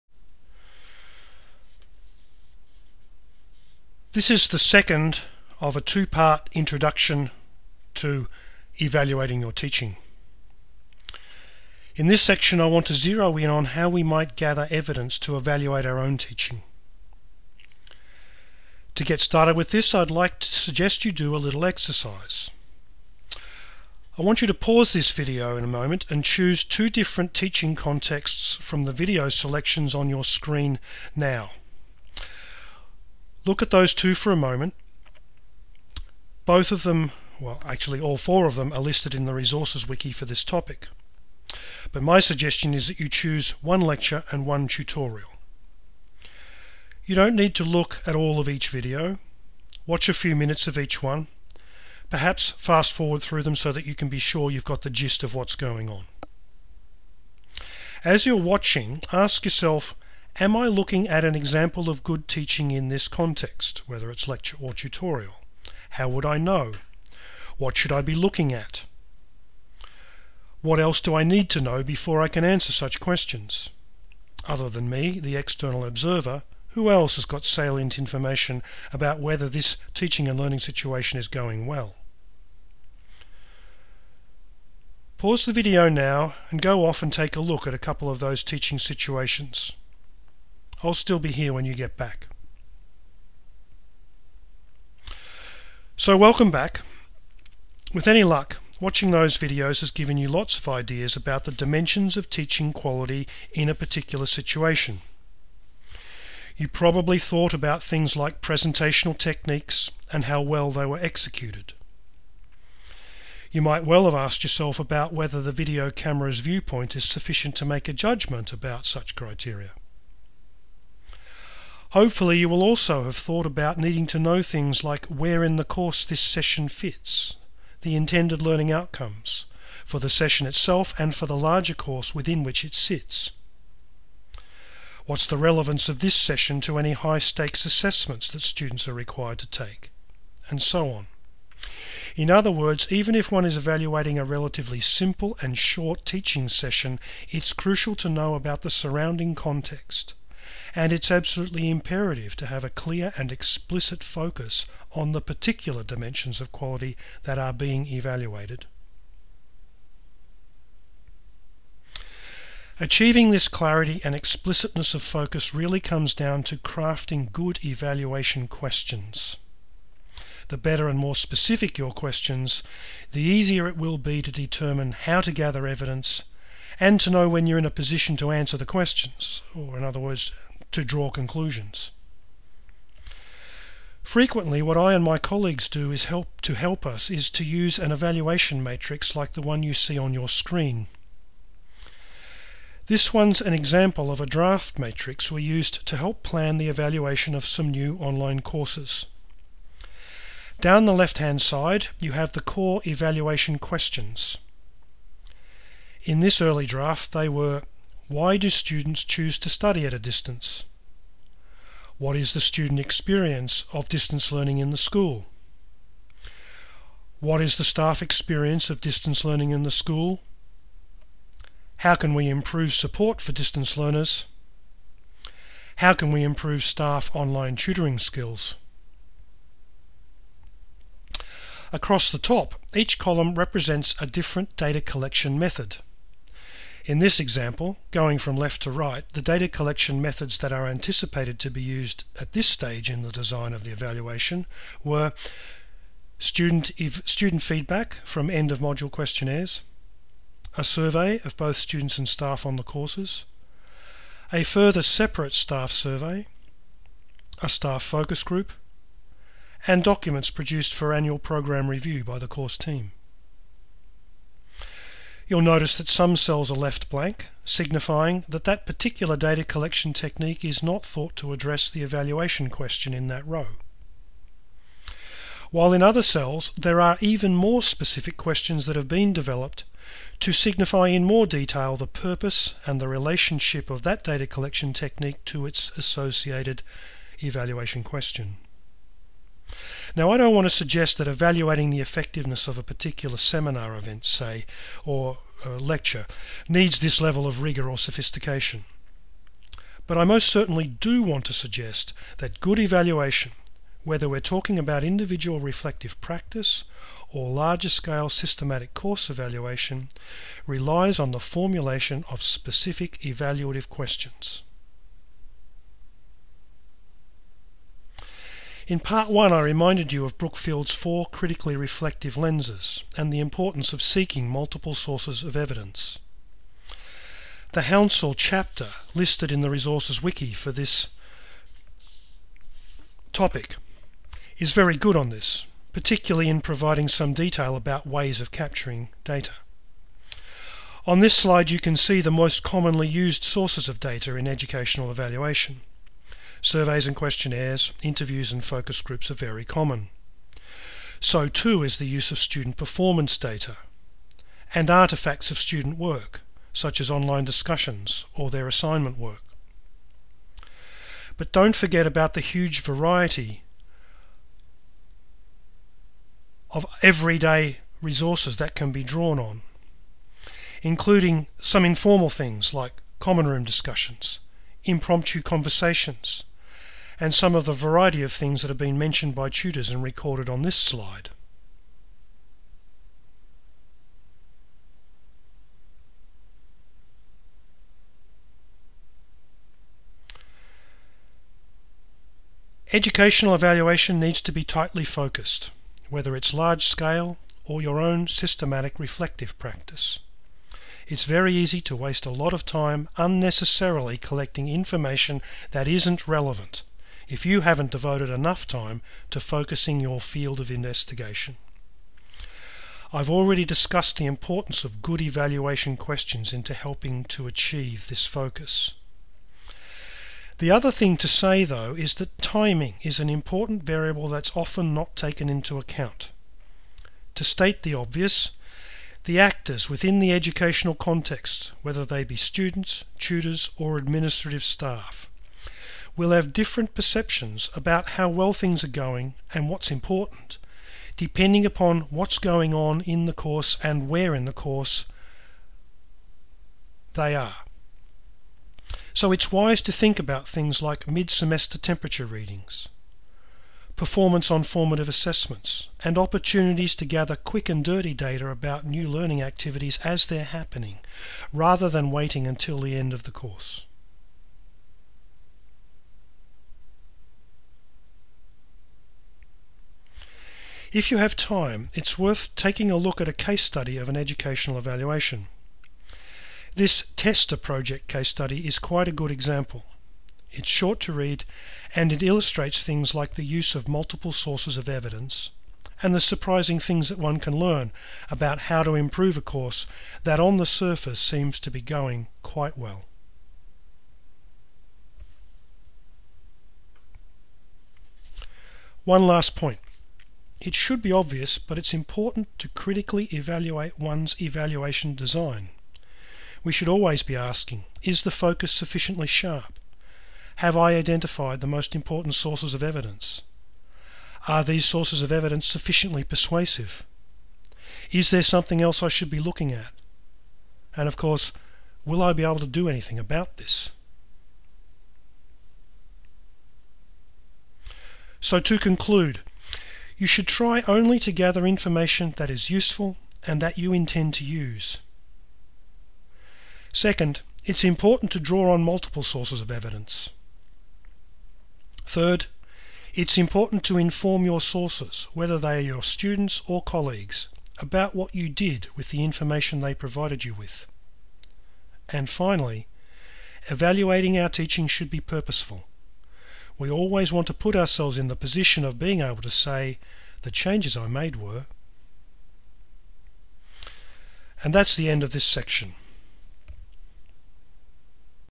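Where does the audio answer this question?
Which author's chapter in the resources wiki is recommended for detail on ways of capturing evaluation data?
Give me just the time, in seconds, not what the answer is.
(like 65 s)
327 s.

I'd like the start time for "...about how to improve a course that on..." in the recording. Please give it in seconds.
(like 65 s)
488 s.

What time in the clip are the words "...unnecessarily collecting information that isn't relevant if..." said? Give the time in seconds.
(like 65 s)
402 s.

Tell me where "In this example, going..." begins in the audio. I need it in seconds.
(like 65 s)
236 s.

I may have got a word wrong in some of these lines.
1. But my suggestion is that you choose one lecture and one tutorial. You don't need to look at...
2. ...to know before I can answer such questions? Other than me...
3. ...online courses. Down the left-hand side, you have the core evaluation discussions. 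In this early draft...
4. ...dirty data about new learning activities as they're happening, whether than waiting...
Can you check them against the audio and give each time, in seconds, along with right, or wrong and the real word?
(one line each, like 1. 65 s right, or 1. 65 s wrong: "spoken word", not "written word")
1. 41 s right
2. 71 s right
3. 197 s wrong: "questions", not "discussions"
4. 457 s wrong: "rather", not "whether".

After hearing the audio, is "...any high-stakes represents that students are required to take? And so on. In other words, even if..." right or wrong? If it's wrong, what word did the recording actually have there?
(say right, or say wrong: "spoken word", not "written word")
wrong: "assessments", not "represents".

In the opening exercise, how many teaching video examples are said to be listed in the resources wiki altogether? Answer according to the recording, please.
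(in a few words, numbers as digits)
4.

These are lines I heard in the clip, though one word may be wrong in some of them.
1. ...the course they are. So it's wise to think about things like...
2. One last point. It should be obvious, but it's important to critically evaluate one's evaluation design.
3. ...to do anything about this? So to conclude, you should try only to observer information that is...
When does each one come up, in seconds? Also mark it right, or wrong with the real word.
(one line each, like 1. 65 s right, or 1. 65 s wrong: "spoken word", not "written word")
1. 444 s right
2. 498 s right
3. 522 s wrong: "gather", not "observer".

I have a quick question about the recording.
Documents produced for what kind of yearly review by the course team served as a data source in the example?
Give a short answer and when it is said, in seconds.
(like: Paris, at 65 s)
Annual program review, at 260 s.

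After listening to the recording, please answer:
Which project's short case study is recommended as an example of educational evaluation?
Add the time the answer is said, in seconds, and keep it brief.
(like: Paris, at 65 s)
TESTA, at 476 s.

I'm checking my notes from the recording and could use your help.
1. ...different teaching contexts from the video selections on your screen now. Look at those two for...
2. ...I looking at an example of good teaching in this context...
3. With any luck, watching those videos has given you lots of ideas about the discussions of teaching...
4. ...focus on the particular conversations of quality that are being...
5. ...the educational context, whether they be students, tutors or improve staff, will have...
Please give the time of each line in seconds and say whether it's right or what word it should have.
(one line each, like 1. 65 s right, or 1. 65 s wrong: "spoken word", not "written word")
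1. 26 s right
2. 60 s right
3. 97 s wrong: "dimensions", not "discussions"
4. 154 s wrong: "dimensions", not "conversations"
5. 429 s wrong: "administrative", not "improve".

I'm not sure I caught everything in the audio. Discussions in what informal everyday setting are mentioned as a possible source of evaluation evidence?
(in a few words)
Common room.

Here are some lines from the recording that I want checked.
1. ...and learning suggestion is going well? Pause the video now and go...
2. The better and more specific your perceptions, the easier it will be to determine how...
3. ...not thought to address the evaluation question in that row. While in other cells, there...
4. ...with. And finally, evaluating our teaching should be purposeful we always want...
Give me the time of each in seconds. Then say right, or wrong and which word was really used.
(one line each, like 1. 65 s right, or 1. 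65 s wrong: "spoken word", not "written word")
1. 80 s wrong: "situation", not "suggestion"
2. 170 s wrong: "questions", not "perceptions"
3. 270 s right
4. 550 s right.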